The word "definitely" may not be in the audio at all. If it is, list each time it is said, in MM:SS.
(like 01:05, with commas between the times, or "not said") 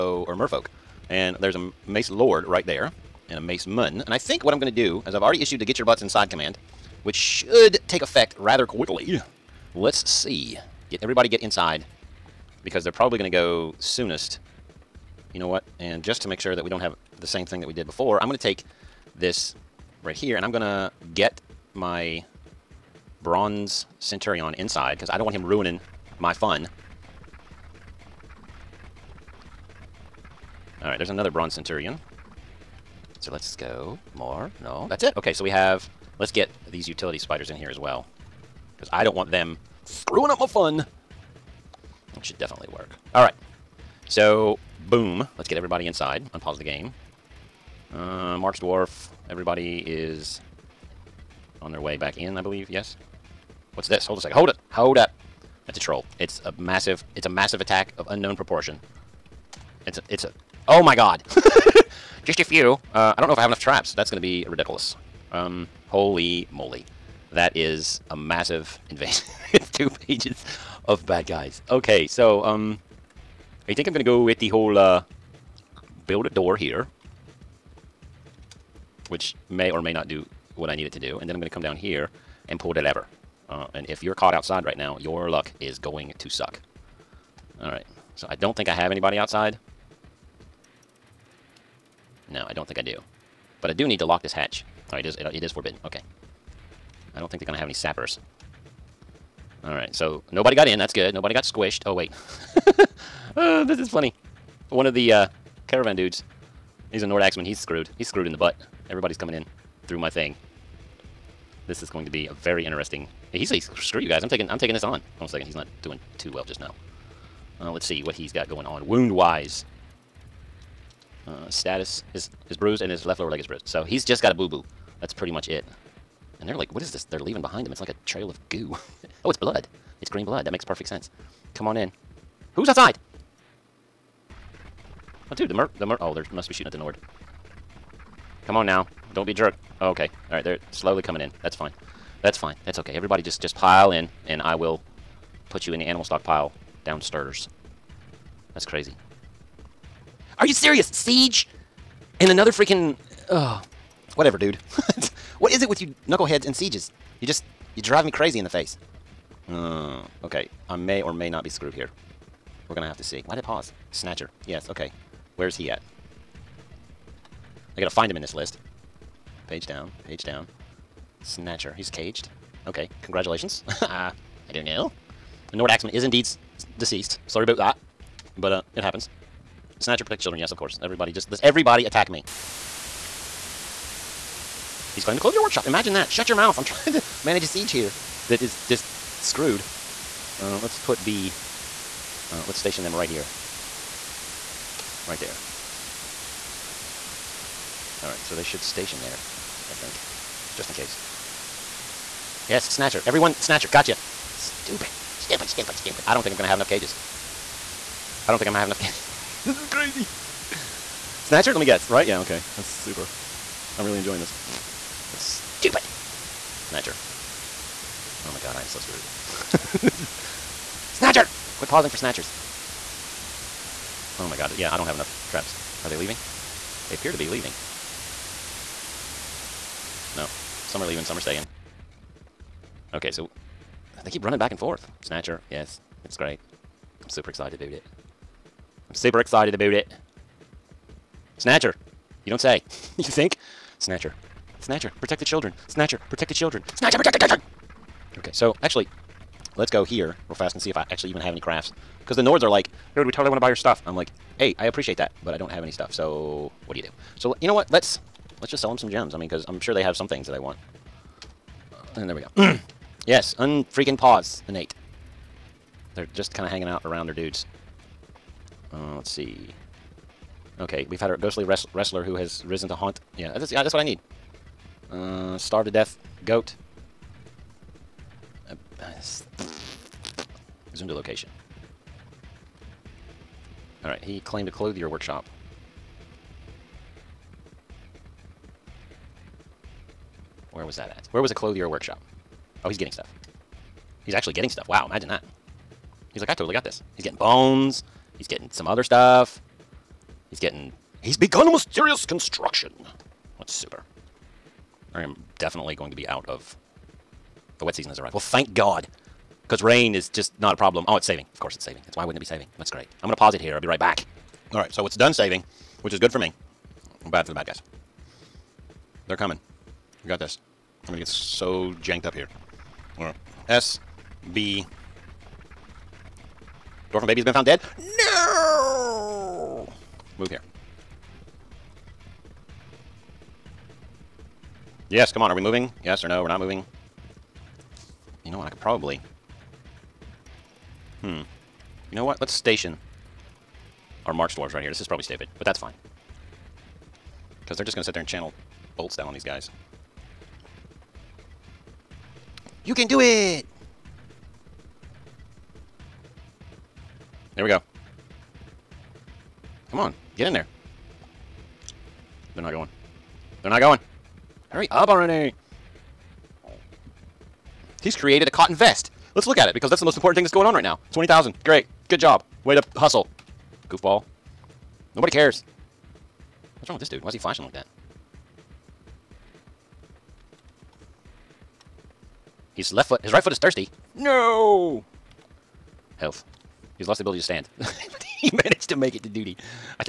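00:42, 05:05.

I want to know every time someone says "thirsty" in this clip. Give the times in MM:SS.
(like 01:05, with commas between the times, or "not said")
06:23.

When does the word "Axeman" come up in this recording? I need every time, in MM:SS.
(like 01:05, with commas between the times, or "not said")
01:47, 02:55.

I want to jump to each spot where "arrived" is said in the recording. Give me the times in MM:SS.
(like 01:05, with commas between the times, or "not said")
05:07.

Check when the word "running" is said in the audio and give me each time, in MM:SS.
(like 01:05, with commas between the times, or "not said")
03:54.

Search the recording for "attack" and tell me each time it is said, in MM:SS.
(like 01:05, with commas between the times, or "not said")
00:57, 03:01.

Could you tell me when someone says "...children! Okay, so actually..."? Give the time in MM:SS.
04:07.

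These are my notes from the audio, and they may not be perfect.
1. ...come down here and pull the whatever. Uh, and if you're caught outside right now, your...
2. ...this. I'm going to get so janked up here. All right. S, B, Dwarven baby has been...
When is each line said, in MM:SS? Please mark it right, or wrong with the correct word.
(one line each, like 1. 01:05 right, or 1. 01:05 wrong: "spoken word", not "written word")
1. 01:21 wrong: "lever", not "whatever"
2. 05:20 right.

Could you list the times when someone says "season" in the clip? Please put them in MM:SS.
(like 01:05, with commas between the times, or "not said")
05:07.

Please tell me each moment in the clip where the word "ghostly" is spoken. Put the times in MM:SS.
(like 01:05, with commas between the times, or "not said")
04:31.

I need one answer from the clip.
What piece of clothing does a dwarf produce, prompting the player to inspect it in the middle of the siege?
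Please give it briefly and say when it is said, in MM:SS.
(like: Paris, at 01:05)
Cotton vest, at 06:08.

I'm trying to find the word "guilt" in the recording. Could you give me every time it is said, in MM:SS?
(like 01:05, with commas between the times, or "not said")
not said.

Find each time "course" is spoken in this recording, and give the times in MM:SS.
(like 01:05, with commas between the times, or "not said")
03:00, 05:11.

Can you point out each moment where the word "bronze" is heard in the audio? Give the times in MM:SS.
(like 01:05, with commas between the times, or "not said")
00:23, 00:31.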